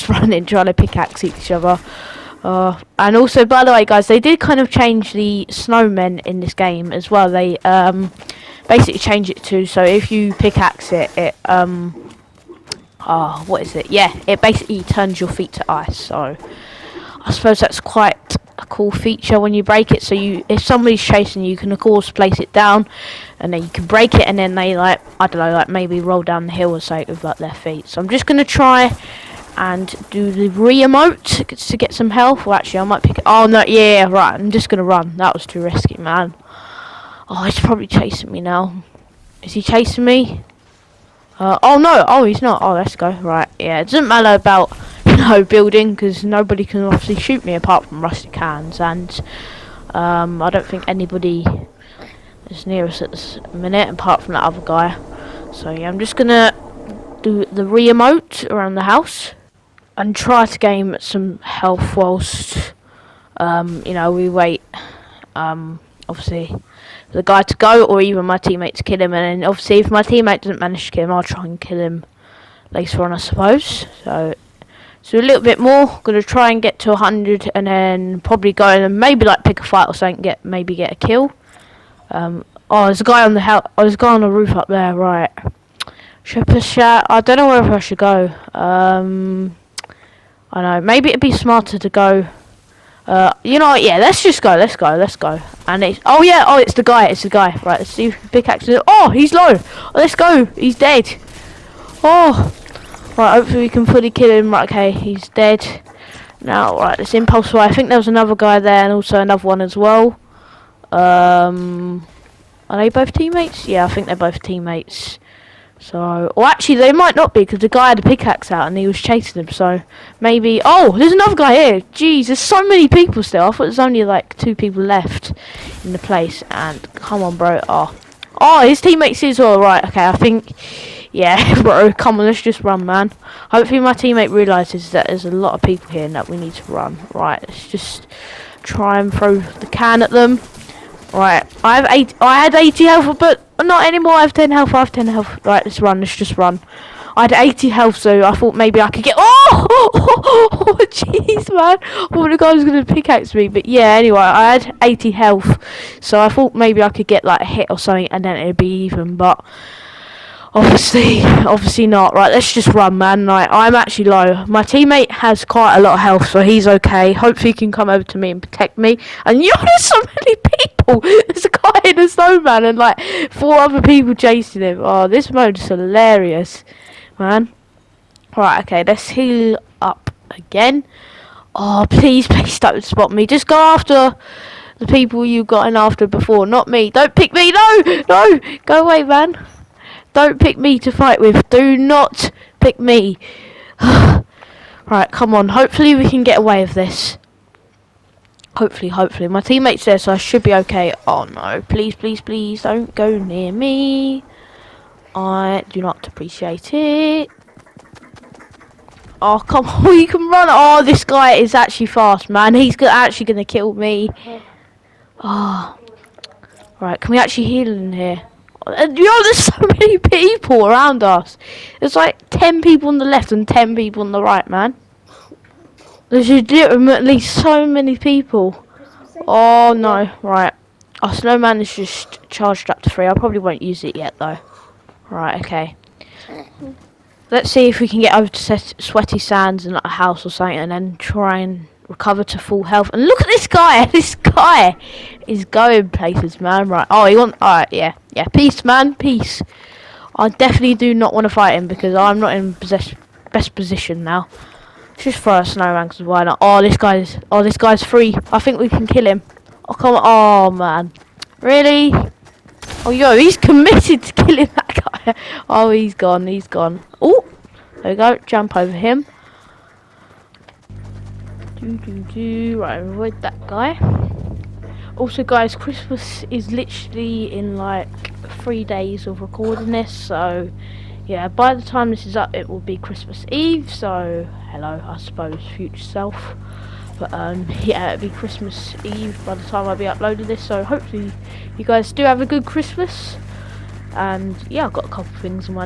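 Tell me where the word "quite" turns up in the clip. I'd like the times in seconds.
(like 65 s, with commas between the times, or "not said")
17 s, 165 s.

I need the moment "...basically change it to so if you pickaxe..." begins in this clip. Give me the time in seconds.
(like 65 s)
8 s.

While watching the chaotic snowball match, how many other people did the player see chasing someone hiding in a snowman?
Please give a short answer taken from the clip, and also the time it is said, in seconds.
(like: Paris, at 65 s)
4, at 173 s.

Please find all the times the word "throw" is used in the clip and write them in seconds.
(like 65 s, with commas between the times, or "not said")
139 s, 255 s.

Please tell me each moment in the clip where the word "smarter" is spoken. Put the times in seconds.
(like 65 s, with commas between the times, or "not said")
91 s.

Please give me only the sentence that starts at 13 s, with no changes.
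Yeah, it basically turns your feet to ice.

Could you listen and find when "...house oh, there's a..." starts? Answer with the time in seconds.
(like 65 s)
83 s.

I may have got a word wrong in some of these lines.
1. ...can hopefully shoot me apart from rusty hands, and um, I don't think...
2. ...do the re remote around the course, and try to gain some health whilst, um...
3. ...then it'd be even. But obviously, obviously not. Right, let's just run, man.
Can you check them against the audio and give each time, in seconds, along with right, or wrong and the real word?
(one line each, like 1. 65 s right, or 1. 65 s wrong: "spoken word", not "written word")
1. 46 s wrong: "obviously", not "hopefully"
2. 57 s wrong: "house", not "course"
3. 158 s right.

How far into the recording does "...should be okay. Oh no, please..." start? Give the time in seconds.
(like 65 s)
200 s.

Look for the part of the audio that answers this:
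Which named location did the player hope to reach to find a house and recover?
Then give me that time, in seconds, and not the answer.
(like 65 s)
238 s.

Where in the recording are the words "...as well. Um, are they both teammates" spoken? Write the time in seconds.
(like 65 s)
109 s.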